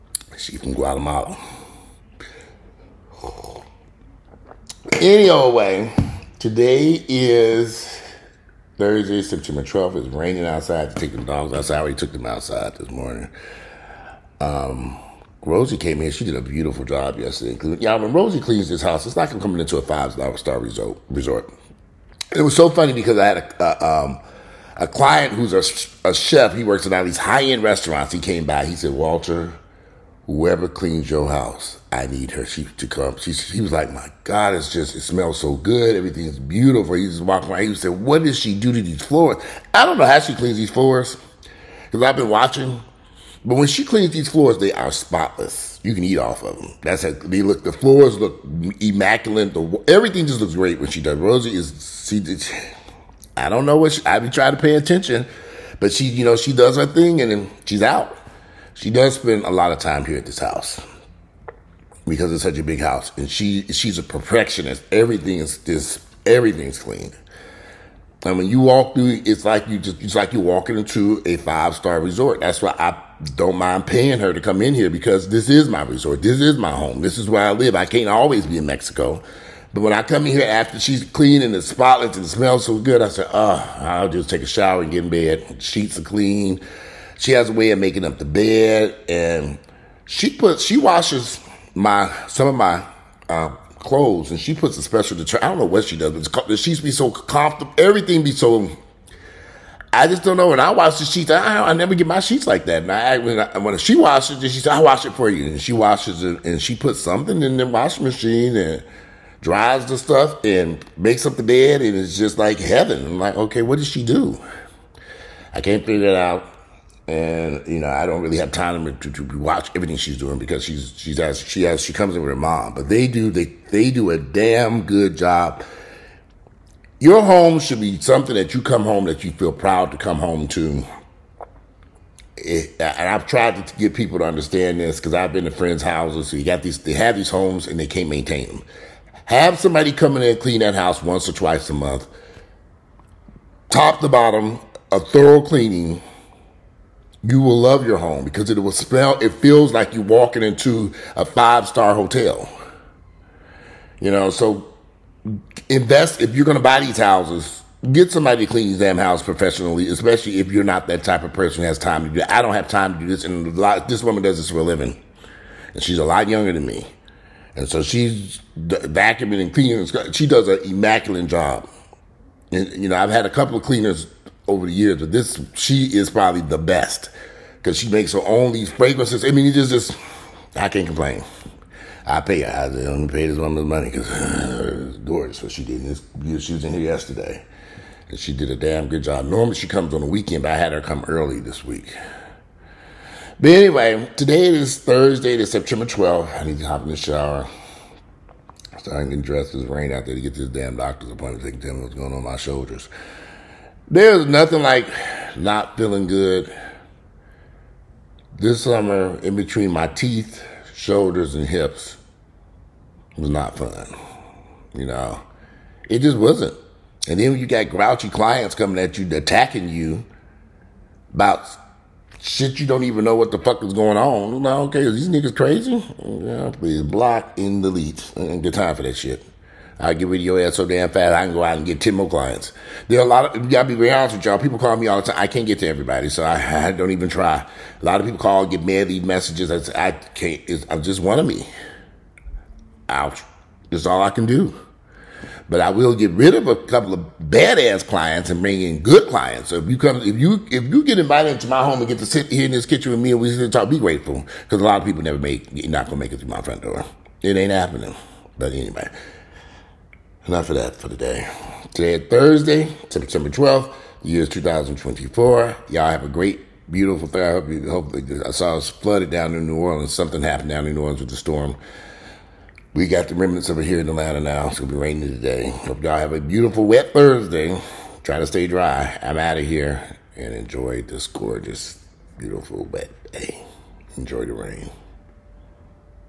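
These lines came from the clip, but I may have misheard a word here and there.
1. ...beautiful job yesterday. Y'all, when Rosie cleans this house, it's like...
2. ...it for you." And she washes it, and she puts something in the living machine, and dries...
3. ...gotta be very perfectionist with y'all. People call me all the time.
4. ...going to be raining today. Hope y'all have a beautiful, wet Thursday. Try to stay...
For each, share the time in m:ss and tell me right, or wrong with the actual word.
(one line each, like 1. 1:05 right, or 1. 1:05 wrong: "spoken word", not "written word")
1. 0:16 right
2. 1:45 wrong: "washing", not "living"
3. 3:53 wrong: "honest", not "perfectionist"
4. 4:34 right.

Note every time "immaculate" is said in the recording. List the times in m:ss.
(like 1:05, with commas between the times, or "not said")
0:48, 2:50.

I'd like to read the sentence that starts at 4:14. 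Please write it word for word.
Cause a lot of people never make, you're not gonna make it through my front door.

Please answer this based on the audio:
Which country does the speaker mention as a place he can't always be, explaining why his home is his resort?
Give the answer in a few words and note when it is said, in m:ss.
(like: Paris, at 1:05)
Mexico, at 1:18.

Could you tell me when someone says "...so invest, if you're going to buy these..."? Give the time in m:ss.
2:34.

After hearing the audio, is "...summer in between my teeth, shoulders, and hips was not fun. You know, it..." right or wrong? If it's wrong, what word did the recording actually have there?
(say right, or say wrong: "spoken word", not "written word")
right.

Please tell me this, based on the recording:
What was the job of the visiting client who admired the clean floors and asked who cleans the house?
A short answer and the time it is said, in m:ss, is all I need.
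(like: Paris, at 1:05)
Chef, at 0:26.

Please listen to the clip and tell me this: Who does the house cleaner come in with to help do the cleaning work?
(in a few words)
Her mom.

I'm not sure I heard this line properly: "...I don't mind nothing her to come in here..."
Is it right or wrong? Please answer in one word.
wrong.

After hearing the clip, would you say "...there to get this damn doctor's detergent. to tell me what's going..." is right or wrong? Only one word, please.
wrong.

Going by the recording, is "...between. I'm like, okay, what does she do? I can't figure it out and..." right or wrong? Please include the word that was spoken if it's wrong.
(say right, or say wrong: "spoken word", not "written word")
wrong: "heaven", not "between".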